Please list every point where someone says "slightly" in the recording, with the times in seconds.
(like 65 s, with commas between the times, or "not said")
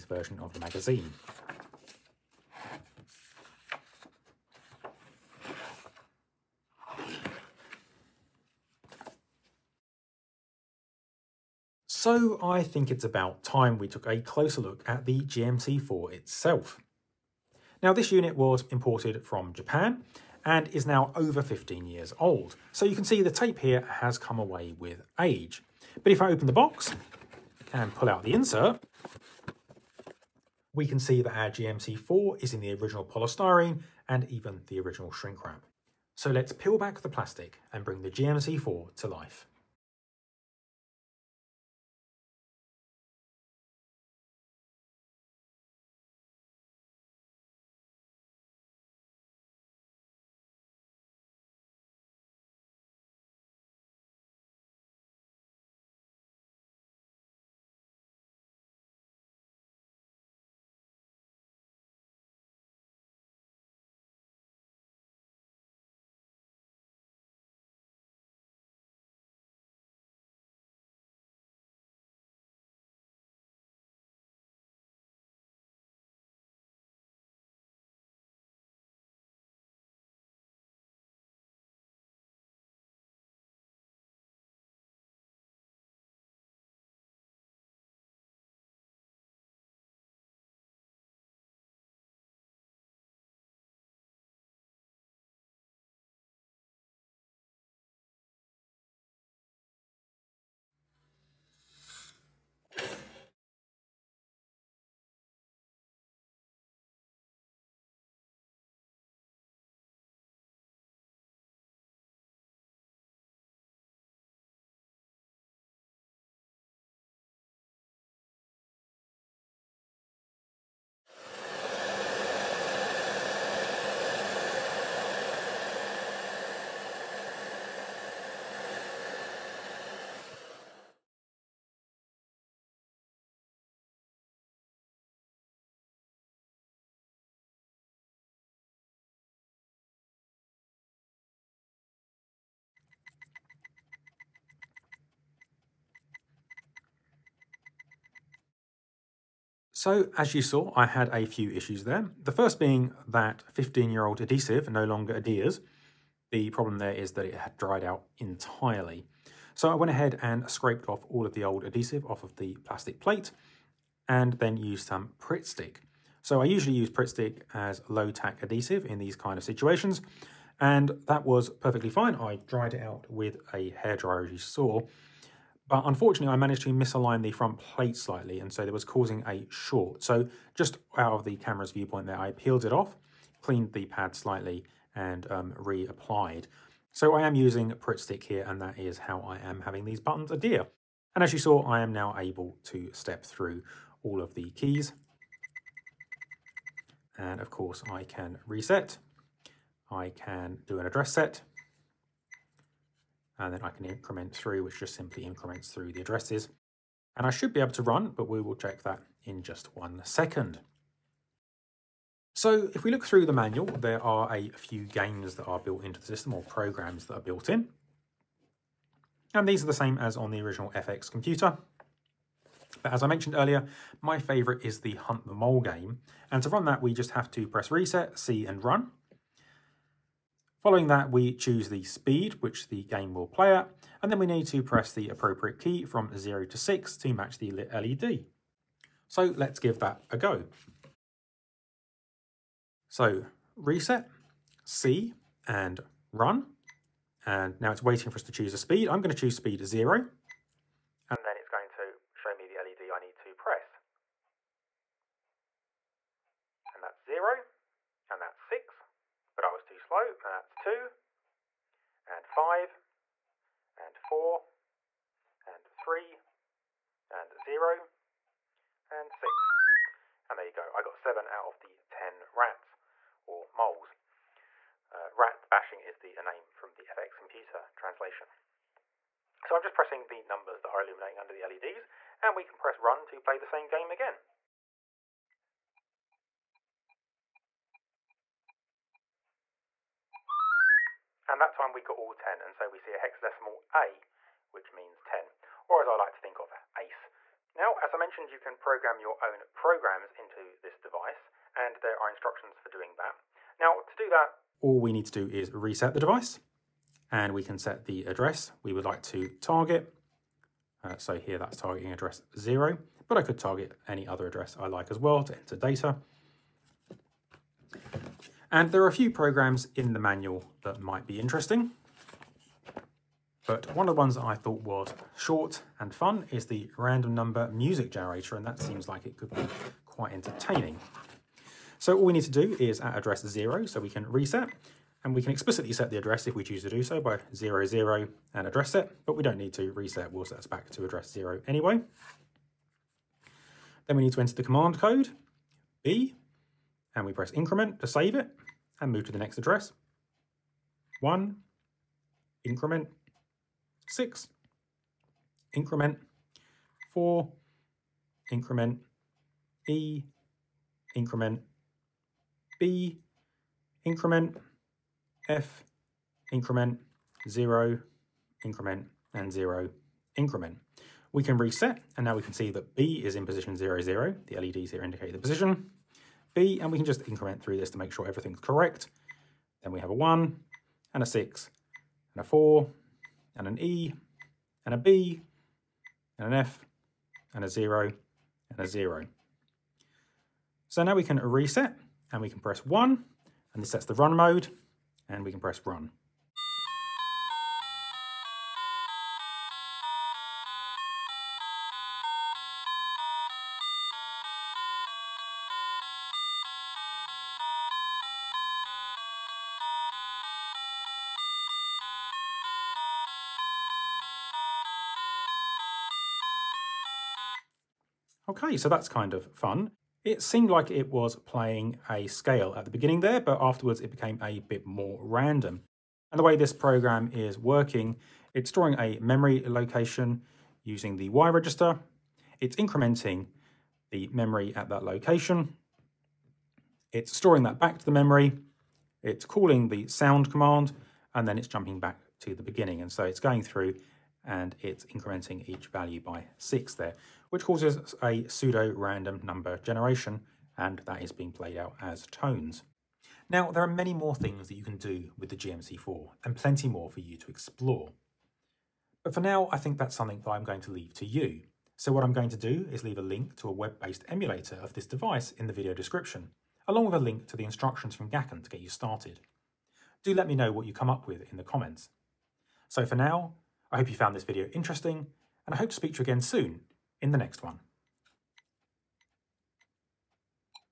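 177 s, 184 s.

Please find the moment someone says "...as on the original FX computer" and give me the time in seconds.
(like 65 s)
219 s.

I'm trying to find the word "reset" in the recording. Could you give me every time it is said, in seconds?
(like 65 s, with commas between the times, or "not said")
198 s, 227 s, 243 s, 305 s, 334 s, 339 s, 371 s, 391 s.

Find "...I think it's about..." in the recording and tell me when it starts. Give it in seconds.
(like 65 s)
12 s.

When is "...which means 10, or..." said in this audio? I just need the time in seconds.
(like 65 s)
294 s.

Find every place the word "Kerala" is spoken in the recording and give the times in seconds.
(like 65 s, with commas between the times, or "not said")
not said.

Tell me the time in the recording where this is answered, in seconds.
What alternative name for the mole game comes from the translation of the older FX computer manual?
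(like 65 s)
275 s.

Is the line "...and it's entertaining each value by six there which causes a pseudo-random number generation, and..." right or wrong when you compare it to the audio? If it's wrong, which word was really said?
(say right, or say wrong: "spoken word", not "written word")
wrong: "incrementing", not "entertaining".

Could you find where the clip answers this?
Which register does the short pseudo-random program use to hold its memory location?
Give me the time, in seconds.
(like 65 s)
431 s.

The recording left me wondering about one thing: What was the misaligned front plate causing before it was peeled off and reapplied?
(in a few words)
A short.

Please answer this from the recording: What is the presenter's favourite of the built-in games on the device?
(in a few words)
Hunt the Mole.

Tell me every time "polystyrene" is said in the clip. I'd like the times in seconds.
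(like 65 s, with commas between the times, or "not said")
33 s.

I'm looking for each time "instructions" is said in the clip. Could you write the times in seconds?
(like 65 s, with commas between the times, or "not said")
302 s, 467 s.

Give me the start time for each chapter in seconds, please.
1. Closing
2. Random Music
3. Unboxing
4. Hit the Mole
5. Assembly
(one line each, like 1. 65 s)
1. 452 s
2. 317 s
3. 12 s
4. 223 s
5. 71 s.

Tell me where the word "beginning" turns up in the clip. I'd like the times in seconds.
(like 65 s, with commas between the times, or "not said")
422 s, 442 s.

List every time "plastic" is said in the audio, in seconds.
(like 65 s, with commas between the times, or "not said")
37 s, 162 s.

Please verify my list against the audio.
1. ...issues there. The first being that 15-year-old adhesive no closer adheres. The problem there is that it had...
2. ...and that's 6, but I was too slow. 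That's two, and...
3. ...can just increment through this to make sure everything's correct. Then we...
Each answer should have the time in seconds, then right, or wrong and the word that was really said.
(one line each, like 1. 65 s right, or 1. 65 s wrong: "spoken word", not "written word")
1. 151 s wrong: "longer", not "closer"
2. 258 s right
3. 376 s right.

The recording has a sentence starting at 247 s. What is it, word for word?
And now it's waiting for us to choose a speed.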